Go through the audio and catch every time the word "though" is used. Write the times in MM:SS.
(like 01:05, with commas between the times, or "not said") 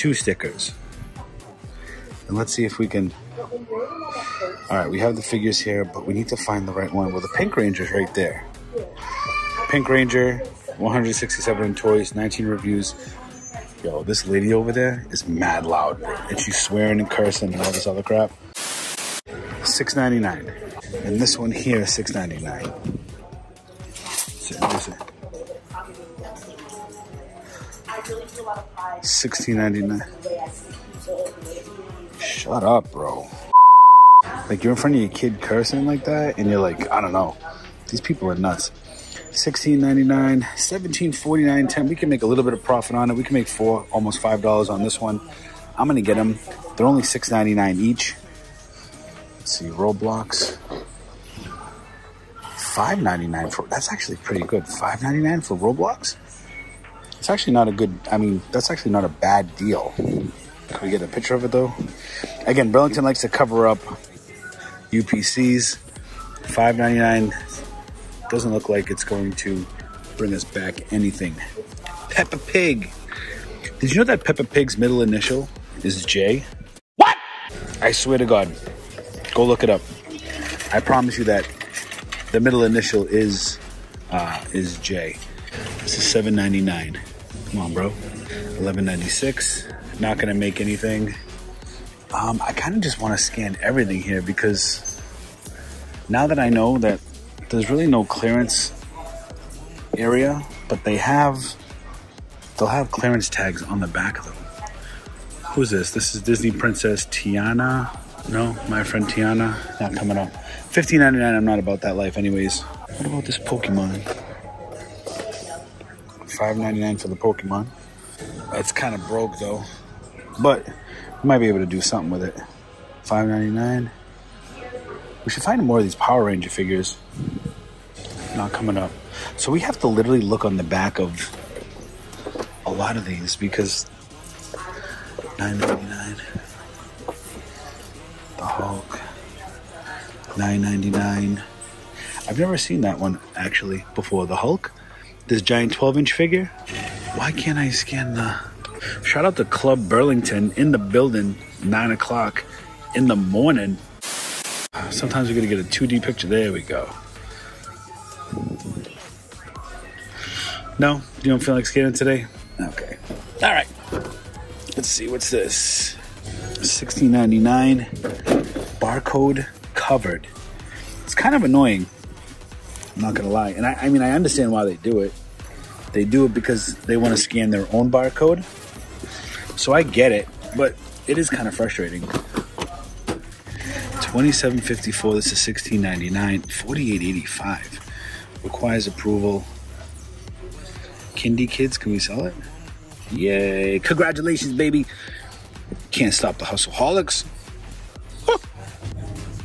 01:01, 01:59.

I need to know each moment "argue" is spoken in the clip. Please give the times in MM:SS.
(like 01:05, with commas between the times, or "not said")
not said.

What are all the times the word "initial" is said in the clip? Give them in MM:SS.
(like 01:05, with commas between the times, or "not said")
01:14, 01:22.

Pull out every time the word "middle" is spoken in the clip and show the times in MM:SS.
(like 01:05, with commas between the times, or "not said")
01:14, 01:22.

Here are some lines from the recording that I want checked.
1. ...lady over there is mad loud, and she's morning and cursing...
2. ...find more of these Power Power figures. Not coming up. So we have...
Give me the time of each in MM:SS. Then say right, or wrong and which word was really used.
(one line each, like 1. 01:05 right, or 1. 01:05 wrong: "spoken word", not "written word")
1. 00:14 wrong: "swearing", not "morning"
2. 02:05 wrong: "Ranger", not "Power".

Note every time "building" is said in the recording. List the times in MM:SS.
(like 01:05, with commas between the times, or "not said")
02:30.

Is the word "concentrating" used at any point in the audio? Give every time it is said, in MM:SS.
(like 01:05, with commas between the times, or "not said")
not said.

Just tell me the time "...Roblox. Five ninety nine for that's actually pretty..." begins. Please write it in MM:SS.
00:49.